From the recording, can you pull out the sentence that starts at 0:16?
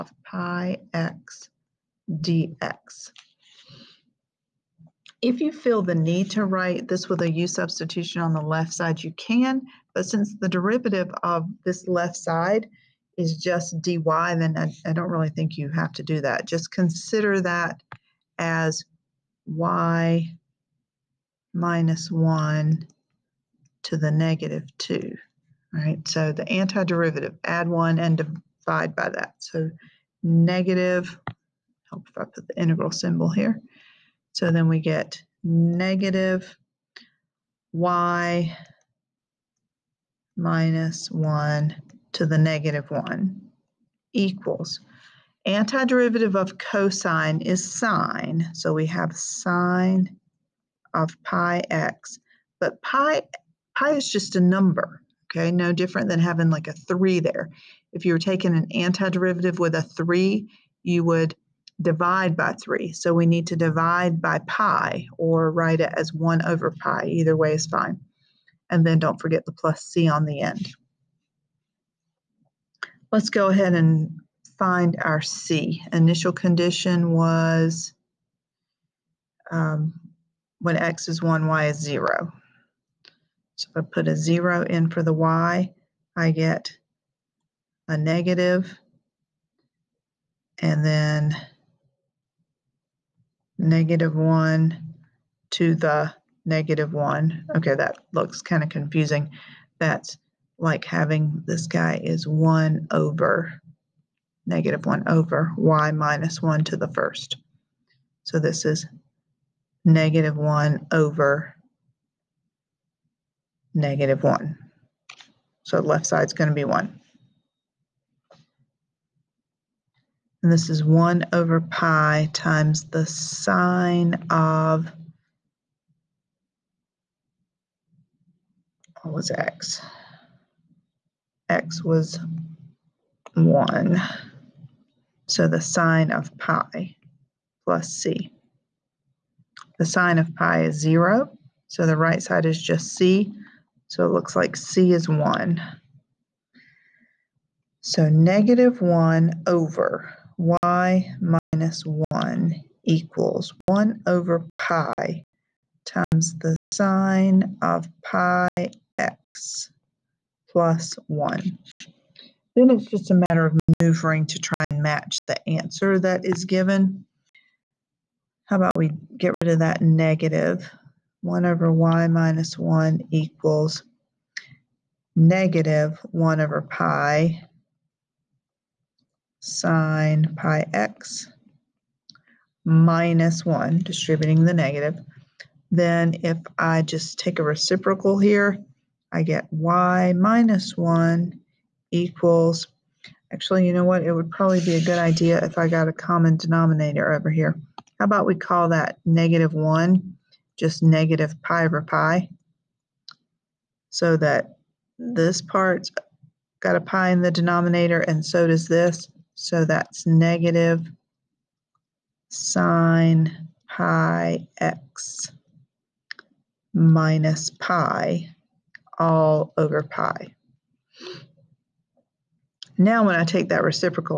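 Just consider that as y minus 1 to the negative 2, right?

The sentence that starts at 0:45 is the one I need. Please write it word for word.
Antiderivative of cosine is sine, so we have sine of pi x.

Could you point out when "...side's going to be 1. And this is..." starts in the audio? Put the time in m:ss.
1:56.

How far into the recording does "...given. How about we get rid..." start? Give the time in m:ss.
2:46.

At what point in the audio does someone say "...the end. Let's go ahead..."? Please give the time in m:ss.
1:10.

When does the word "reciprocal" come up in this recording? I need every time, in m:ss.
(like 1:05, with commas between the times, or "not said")
3:07, 3:43.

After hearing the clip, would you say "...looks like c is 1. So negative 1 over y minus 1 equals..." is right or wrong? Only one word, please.
right.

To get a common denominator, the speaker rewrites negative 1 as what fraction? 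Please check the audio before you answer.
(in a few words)
negative pi over pi.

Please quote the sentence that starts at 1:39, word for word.
That's like having this guy is 1 over negative 1 over y minus 1 to the first.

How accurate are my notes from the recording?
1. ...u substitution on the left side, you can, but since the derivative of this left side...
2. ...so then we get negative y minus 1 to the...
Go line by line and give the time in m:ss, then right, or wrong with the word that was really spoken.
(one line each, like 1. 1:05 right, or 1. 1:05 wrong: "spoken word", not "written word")
1. 0:07 right
2. 0:34 right.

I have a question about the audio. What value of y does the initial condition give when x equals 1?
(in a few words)
0.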